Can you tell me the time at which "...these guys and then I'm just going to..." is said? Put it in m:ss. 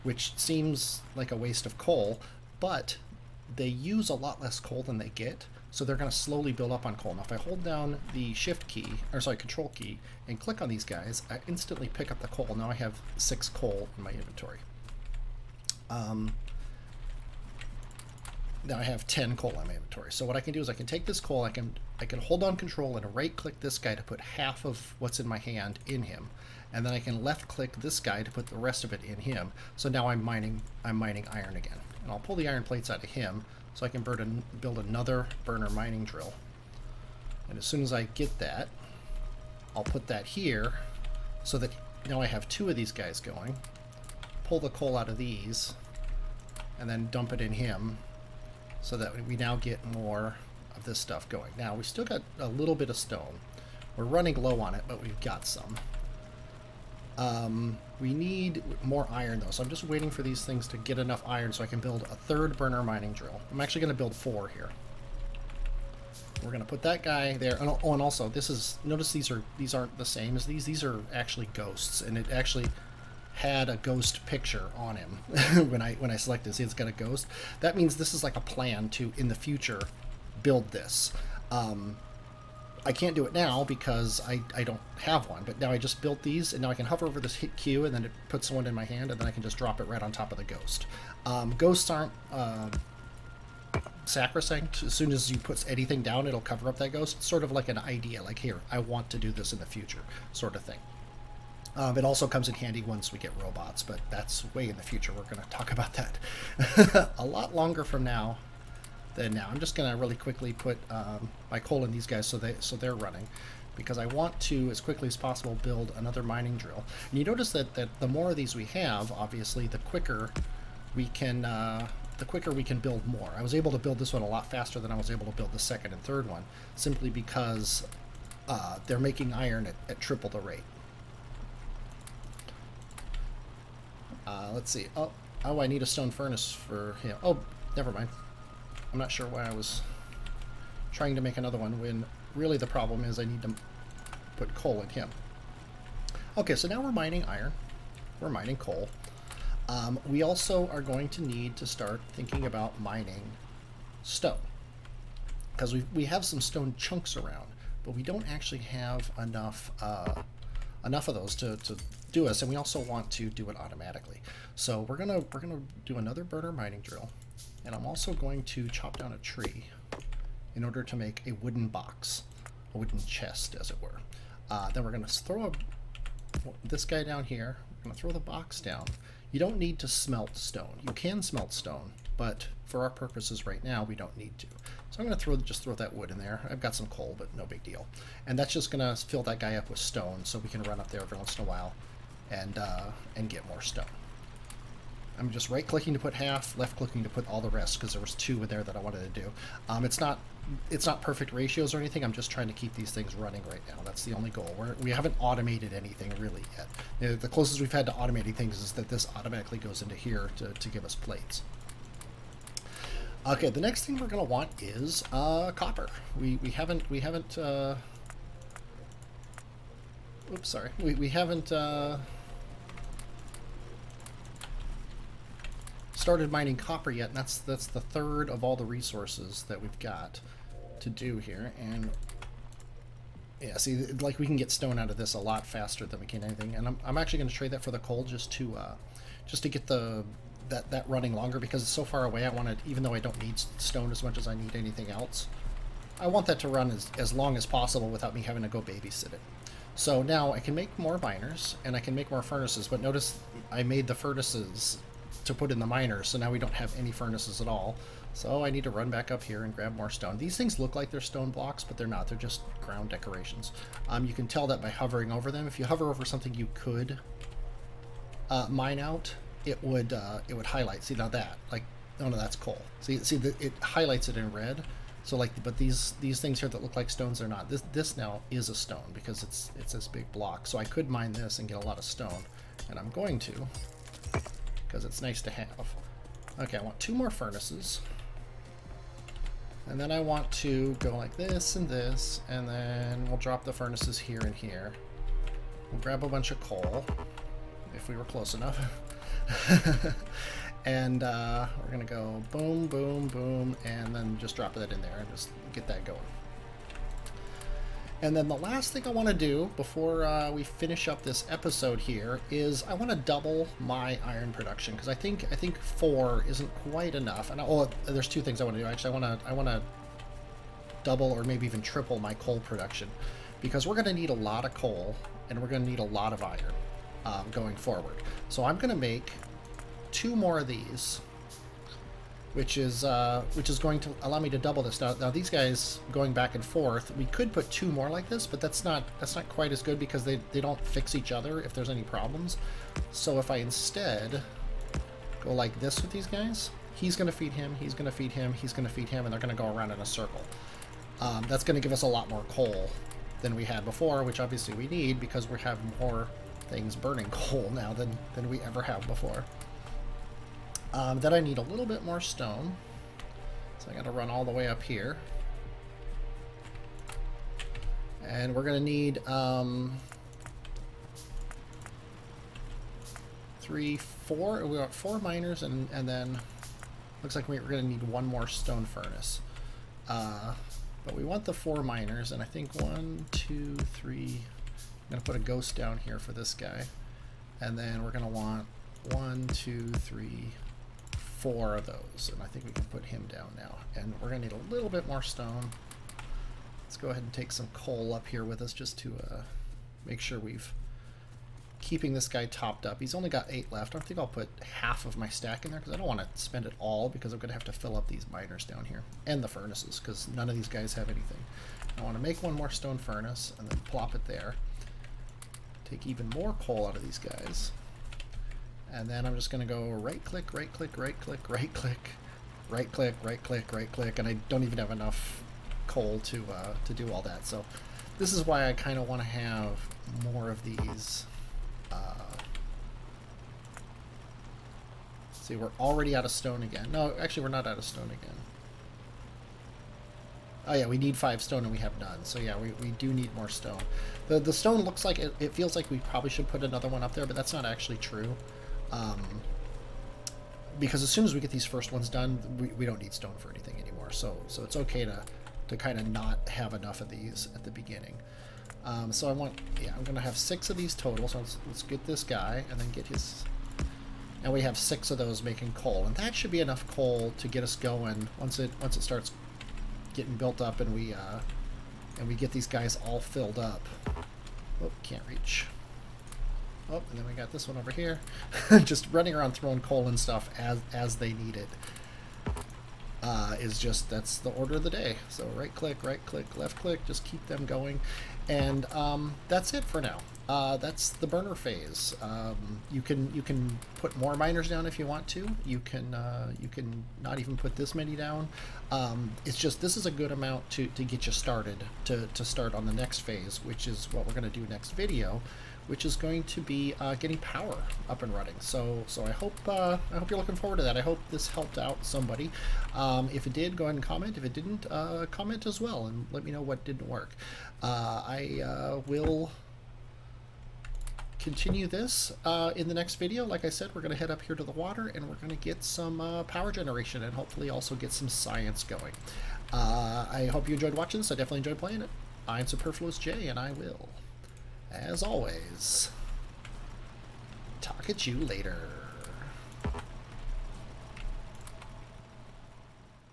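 6:56.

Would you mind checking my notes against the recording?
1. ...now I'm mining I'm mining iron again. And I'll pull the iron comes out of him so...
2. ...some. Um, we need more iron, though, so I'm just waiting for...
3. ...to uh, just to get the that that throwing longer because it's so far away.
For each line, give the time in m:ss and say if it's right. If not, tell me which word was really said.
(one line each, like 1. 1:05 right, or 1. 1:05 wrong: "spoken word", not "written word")
1. 0:29 wrong: "plates", not "comes"
2. 0:55 right
3. 3:58 wrong: "running", not "throwing".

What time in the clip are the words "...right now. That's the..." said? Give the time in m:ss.
3:23.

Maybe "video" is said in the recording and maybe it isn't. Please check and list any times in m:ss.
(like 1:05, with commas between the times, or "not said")
8:24, 8:42.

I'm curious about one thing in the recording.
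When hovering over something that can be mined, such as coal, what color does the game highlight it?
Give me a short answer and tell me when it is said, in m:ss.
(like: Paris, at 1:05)
red, at 4:34.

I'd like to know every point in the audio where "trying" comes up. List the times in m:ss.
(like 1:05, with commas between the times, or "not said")
2:20, 3:22.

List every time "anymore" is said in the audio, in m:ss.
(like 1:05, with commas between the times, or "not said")
7:33.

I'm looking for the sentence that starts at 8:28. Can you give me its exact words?
So, so I hope uh, I hope you're looking forward to that.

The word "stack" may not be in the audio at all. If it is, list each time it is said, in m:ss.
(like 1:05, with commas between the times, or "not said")
6:45.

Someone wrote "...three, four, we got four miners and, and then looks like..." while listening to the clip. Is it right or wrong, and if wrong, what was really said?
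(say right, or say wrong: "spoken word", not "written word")
right.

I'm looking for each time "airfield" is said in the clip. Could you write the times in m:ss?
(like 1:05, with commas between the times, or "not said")
not said.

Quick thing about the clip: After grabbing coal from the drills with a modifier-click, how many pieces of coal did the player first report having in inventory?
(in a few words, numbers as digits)
6.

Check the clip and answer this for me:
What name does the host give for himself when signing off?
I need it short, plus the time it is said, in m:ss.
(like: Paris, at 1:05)
Superfluous J, at 8:52.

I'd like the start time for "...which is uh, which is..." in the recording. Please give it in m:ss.
5:32.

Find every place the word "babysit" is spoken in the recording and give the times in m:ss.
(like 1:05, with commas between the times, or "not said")
4:08.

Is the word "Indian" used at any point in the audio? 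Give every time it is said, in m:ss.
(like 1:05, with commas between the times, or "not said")
not said.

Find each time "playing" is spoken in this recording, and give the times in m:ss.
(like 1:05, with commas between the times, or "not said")
8:51.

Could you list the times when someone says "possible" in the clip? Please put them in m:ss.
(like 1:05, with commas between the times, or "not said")
1:55, 4:07.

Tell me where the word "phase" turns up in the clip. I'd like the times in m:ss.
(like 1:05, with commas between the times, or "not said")
8:11, 8:23.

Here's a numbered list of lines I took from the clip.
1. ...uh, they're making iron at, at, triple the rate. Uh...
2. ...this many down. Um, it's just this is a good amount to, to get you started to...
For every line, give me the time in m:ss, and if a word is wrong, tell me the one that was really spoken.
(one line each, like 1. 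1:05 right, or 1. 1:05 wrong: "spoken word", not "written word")
1. 2:08 right
2. 8:17 right.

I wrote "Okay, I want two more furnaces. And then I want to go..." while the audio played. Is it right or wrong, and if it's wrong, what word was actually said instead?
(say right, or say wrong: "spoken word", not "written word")
right.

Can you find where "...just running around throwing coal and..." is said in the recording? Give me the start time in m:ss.
7:58.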